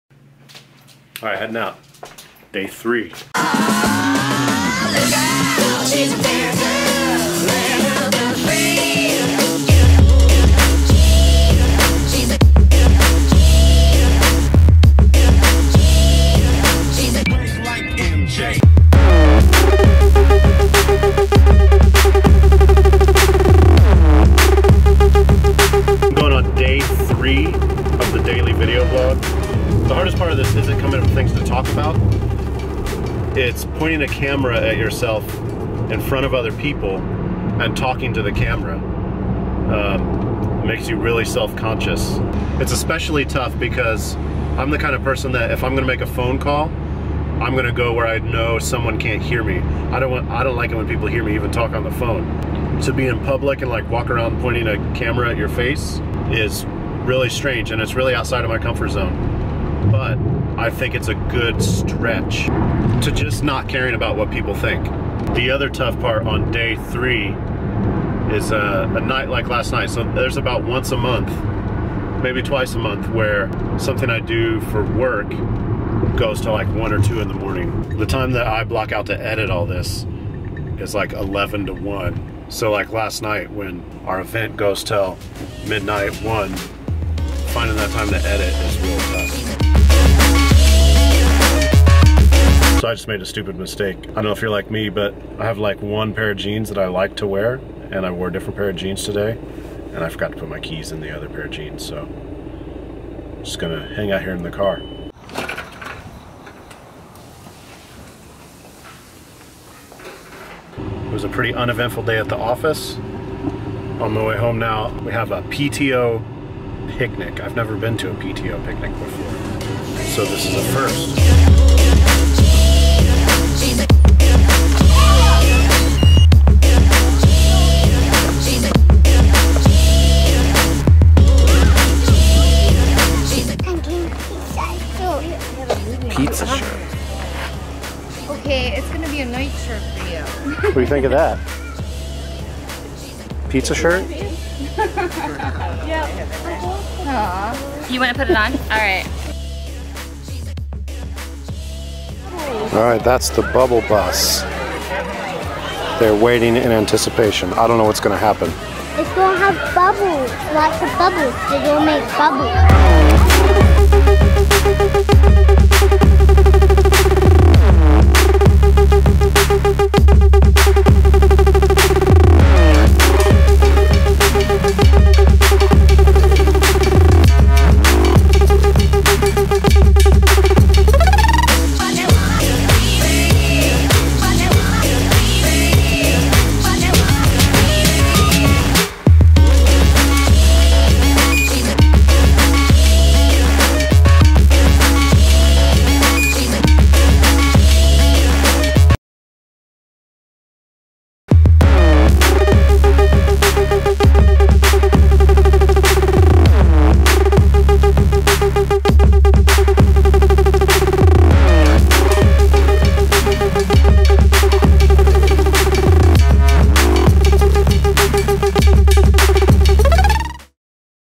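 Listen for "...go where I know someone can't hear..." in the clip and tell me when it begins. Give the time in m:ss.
0:47.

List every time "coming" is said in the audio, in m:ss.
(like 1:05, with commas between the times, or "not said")
0:30.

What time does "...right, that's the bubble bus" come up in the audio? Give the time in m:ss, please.
2:32.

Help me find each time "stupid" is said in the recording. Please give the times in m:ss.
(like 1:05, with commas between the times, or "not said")
1:33.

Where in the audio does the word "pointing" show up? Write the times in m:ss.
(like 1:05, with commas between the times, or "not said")
0:33, 0:54.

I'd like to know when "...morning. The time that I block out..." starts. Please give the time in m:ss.
1:17.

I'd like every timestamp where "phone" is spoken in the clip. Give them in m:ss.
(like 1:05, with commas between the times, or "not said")
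0:46, 0:51.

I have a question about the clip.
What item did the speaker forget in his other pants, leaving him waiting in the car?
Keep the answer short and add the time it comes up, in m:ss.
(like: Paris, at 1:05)
Keys, at 1:40.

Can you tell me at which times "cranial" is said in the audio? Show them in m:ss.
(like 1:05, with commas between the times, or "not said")
not said.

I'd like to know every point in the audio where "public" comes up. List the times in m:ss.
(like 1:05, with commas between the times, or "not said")
0:53.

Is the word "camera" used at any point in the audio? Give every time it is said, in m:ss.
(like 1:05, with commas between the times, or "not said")
0:34, 0:38, 0:54.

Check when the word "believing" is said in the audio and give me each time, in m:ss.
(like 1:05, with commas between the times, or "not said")
not said.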